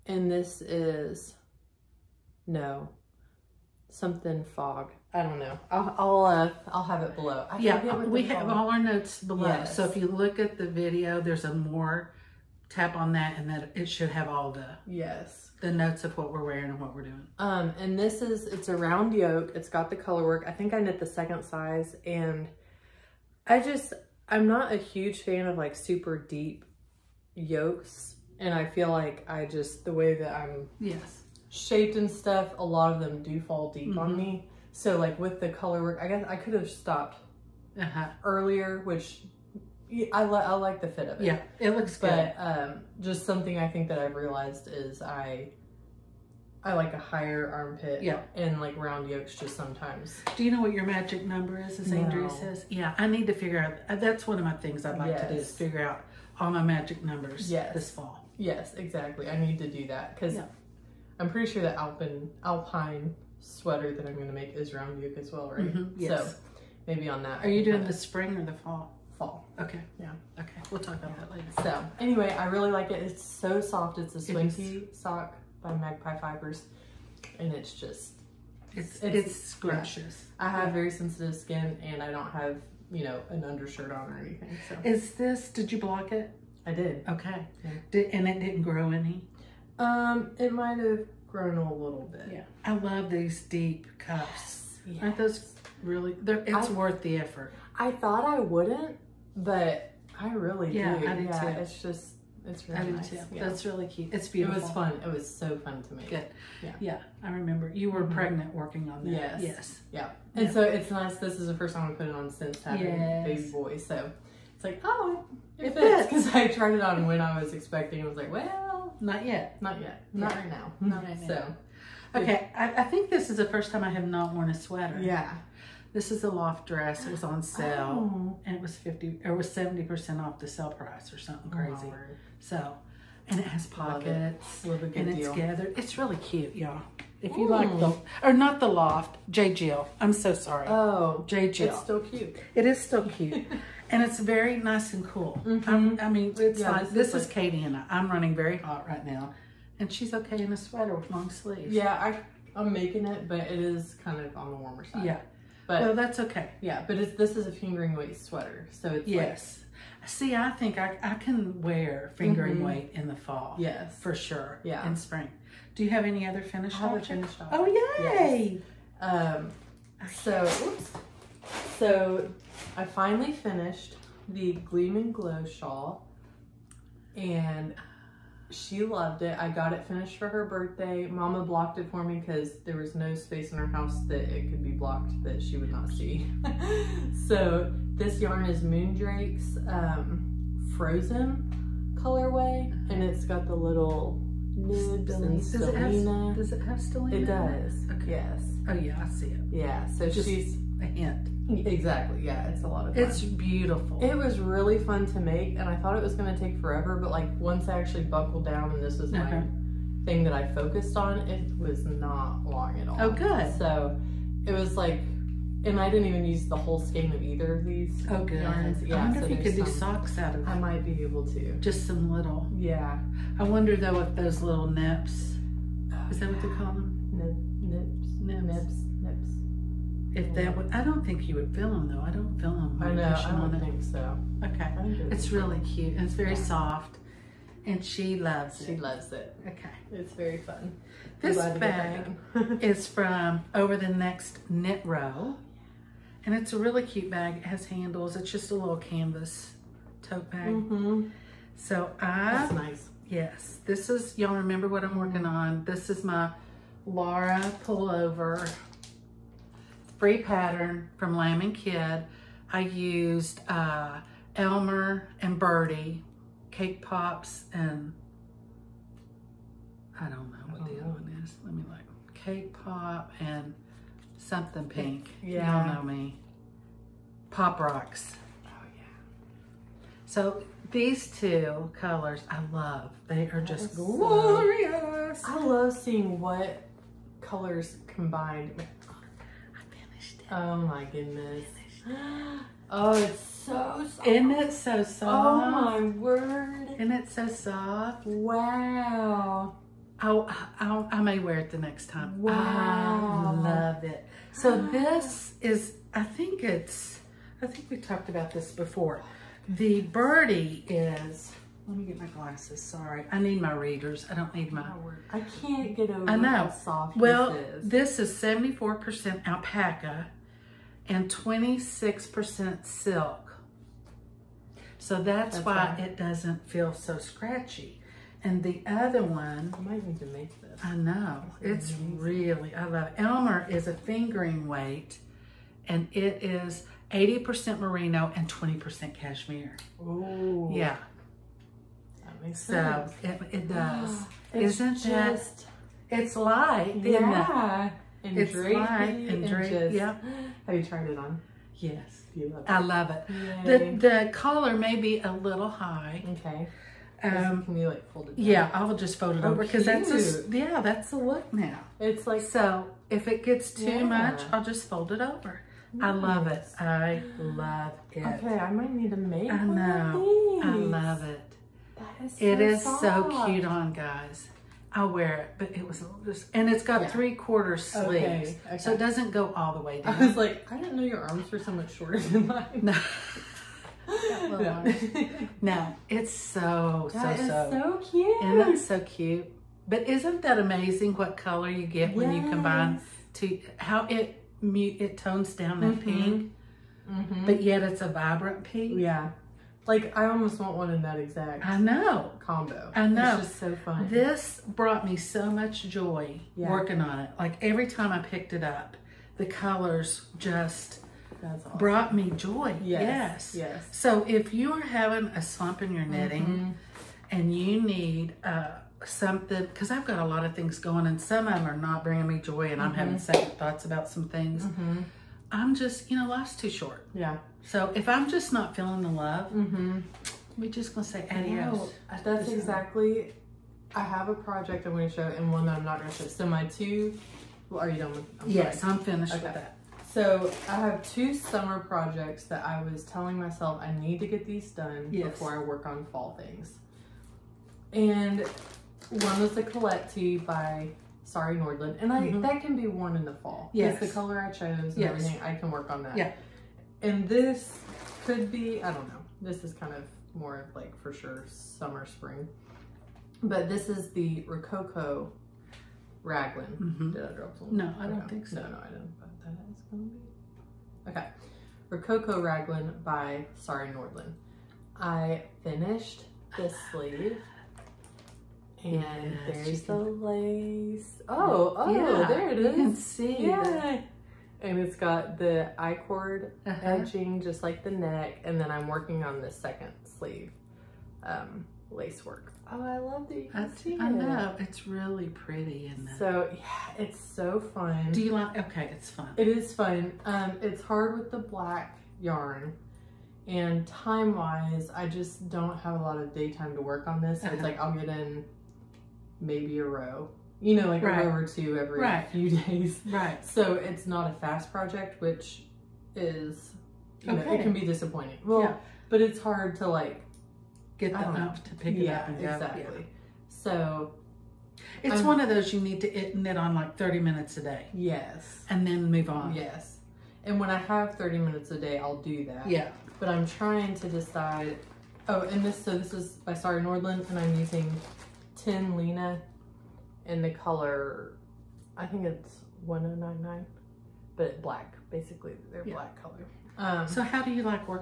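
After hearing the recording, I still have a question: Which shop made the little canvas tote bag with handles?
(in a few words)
Over the Next Knit Row.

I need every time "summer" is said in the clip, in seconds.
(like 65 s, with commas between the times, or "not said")
441 s, 461 s.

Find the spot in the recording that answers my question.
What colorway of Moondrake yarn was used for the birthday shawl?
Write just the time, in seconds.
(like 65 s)
190 s.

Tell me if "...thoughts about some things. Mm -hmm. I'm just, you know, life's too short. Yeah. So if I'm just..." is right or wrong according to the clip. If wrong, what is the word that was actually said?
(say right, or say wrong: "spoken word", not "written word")
right.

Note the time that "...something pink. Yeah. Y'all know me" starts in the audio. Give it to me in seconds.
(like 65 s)
274 s.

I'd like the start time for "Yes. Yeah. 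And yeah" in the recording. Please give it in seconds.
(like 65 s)
109 s.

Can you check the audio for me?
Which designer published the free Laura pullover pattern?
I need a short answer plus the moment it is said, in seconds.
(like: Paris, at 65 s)
Lamb and Kid, at 261 s.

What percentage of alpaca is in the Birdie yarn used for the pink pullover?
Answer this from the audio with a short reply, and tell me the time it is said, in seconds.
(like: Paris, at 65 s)
74%, at 318 s.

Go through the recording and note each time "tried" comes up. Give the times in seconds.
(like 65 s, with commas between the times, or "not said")
116 s, 350 s.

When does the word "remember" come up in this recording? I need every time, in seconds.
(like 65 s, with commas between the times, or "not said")
107 s, 254 s.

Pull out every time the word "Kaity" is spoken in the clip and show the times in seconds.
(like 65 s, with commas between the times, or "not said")
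147 s.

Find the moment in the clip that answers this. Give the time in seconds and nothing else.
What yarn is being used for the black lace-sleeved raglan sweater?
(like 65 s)
538 s.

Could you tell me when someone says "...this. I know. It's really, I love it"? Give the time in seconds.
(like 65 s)
330 s.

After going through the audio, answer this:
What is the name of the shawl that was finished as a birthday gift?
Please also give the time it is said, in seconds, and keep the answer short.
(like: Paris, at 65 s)
Gleam and Glow, at 174 s.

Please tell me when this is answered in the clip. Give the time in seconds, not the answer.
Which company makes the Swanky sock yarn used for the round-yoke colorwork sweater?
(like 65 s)
75 s.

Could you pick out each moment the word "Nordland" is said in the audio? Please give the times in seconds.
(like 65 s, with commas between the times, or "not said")
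451 s, 473 s, 536 s.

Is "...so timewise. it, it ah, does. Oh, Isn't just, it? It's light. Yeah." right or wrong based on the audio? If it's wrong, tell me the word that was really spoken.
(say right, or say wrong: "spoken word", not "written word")
wrong: "sense", not "timewise".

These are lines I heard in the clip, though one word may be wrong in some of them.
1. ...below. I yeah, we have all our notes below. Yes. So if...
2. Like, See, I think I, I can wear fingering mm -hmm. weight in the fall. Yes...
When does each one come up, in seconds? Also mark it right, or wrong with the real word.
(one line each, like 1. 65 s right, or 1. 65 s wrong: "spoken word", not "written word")
1. 7 s right
2. 160 s right.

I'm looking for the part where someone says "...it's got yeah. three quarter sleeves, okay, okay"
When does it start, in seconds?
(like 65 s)
376 s.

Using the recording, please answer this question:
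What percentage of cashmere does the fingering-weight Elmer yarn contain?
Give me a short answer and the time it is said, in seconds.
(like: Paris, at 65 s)
20%, at 338 s.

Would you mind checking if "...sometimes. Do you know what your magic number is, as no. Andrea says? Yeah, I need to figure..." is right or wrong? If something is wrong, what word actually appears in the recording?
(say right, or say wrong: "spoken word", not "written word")
right.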